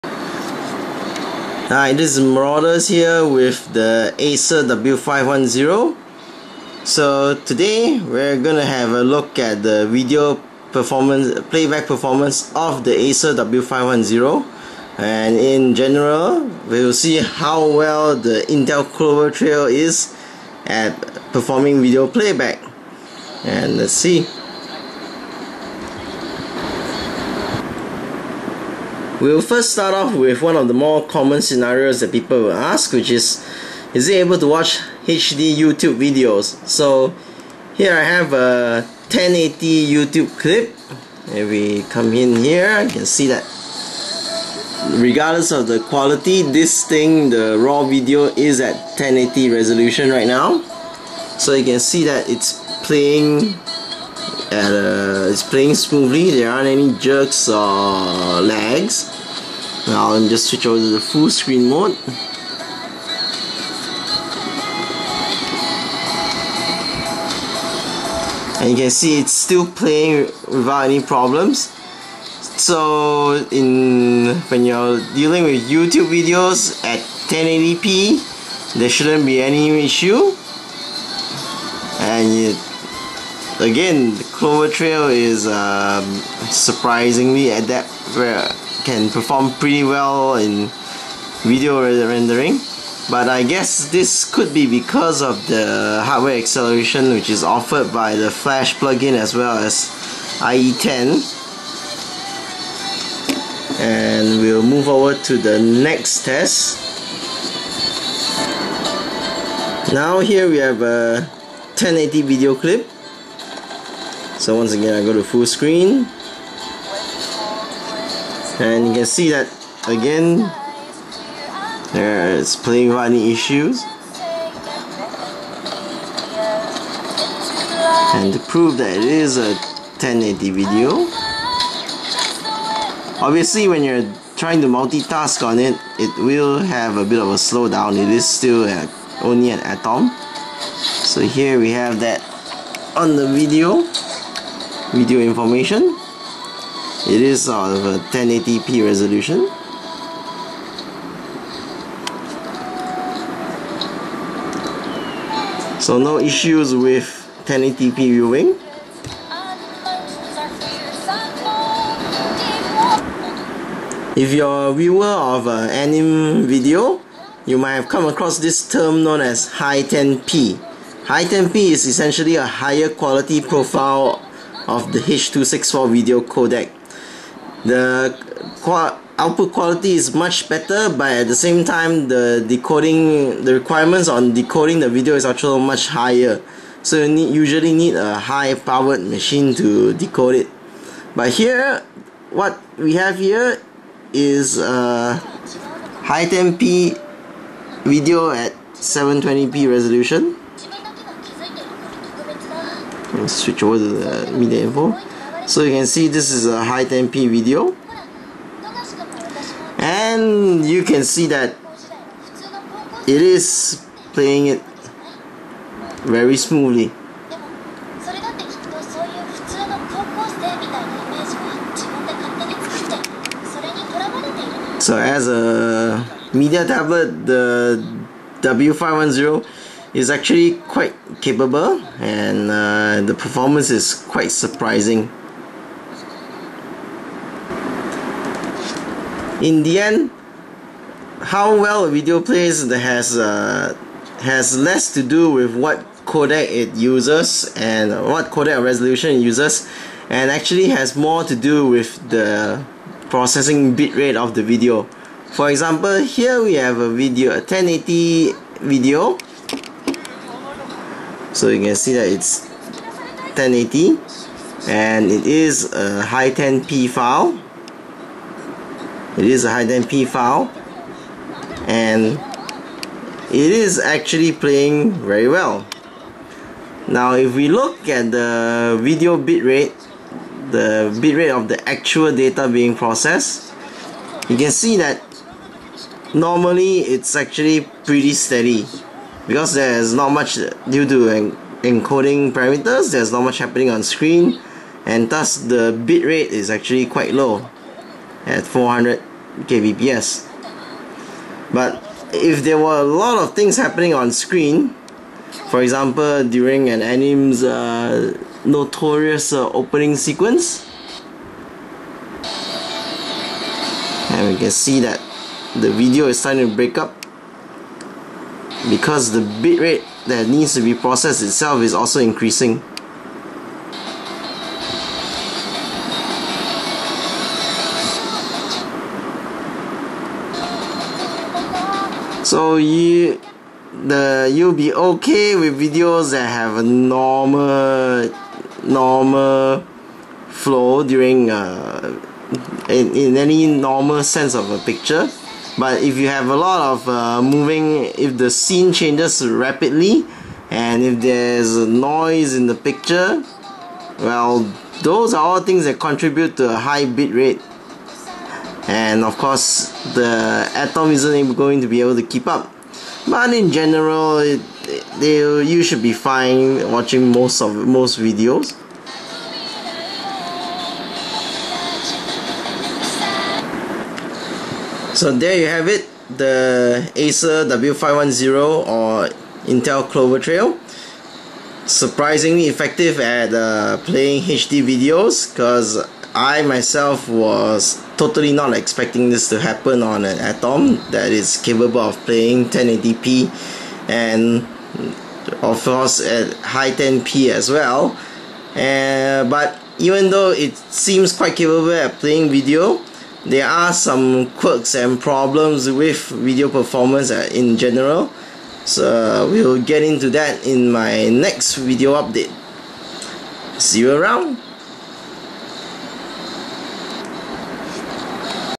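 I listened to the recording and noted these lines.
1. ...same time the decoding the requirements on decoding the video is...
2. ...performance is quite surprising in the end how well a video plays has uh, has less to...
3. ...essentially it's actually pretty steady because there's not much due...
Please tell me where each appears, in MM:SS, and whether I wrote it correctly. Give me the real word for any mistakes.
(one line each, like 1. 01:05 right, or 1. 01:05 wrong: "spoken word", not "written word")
1. 03:01 right
2. 03:53 right
3. 04:46 wrong: "normally", not "essentially".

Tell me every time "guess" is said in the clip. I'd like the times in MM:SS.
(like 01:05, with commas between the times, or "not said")
01:33.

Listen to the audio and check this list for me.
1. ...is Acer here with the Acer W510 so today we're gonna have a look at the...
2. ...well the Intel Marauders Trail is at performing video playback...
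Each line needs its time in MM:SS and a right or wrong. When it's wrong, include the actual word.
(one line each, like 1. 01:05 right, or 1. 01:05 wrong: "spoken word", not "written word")
1. 00:02 wrong: "Marauders", not "Acer"
2. 00:17 wrong: "Clover", not "Marauders".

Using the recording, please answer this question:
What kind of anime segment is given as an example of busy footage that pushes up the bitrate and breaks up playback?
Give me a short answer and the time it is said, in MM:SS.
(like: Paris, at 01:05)
opening sequence, at 05:09.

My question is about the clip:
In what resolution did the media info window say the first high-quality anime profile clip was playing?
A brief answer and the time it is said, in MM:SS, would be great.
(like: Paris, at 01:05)
720p, at 03:18.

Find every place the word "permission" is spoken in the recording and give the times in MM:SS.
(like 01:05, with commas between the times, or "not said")
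not said.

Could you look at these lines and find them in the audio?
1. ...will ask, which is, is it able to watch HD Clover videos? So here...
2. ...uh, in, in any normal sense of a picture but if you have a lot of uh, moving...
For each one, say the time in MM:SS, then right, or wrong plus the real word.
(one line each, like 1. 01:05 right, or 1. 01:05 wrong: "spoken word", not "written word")
1. 00:32 wrong: "YouTube", not "Clover"
2. 05:41 right.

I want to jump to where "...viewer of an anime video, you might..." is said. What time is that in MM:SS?
02:44.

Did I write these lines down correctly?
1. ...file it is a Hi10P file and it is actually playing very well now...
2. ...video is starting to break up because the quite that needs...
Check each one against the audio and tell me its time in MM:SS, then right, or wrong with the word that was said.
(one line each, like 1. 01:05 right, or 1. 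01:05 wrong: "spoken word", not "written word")
1. 04:26 right
2. 05:15 wrong: "bitrate", not "quite".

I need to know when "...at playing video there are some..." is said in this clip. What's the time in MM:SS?
06:41.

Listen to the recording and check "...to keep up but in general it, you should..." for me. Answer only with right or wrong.
right.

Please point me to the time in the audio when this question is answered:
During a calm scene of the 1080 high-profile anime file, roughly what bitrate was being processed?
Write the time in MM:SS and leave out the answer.
04:58.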